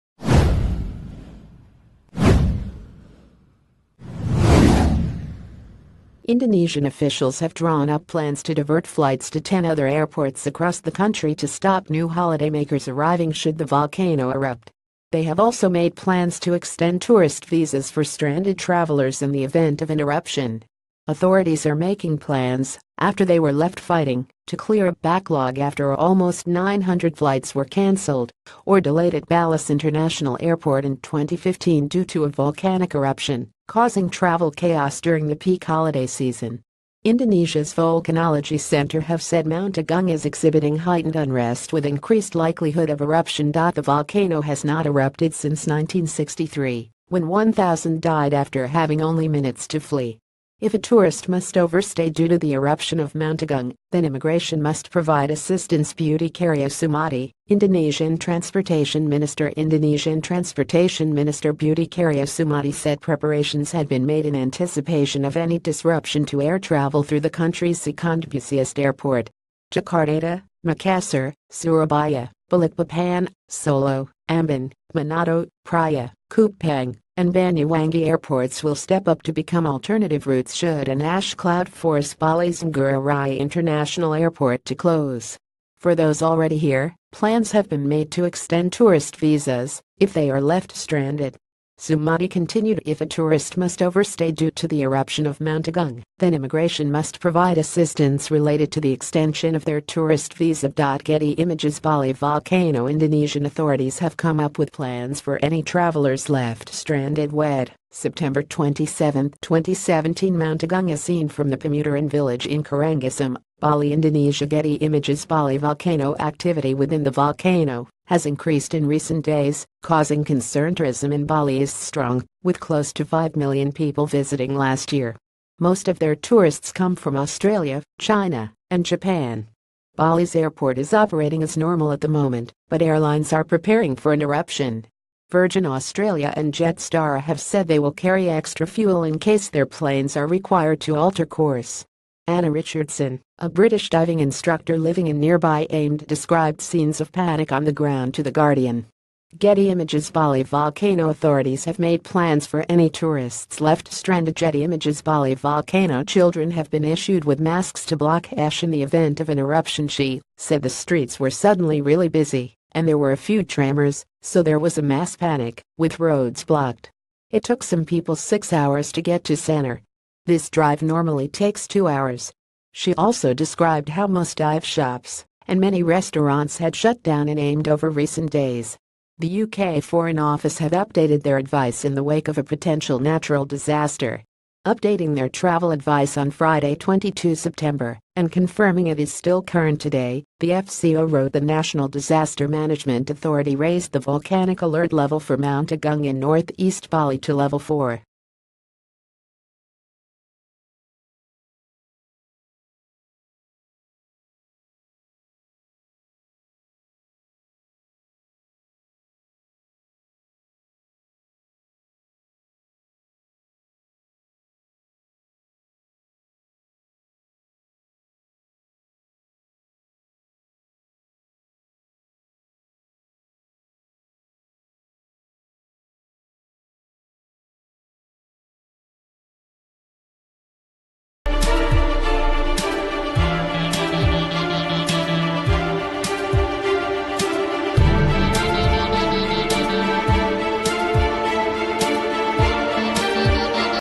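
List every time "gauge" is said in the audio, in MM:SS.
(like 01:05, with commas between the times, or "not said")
not said.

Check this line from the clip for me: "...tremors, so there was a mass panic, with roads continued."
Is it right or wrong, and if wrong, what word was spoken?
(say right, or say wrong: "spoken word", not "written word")
wrong: "blocked", not "continued".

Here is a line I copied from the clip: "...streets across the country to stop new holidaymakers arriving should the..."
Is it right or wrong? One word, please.
wrong.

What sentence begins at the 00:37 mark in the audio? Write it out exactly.
Indonesia's Volcanology Center have said Mount Agung is exhibiting heightened unrest with increased likelihood of eruption.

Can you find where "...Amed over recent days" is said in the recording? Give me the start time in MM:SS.
02:57.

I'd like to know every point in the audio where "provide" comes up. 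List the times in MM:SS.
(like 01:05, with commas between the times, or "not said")
00:54, 01:37.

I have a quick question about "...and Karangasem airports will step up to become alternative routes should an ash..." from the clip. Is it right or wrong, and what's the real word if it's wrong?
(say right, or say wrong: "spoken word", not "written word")
wrong: "Banyuwangi", not "Karangasem".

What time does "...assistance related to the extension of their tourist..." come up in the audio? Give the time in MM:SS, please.
01:37.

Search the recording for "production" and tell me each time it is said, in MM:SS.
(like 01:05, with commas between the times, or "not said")
not said.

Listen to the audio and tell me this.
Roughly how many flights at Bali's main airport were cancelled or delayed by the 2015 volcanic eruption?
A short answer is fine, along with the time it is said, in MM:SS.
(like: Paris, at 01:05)
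900, at 00:25.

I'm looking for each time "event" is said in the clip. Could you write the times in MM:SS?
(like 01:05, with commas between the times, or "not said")
00:19, 02:38.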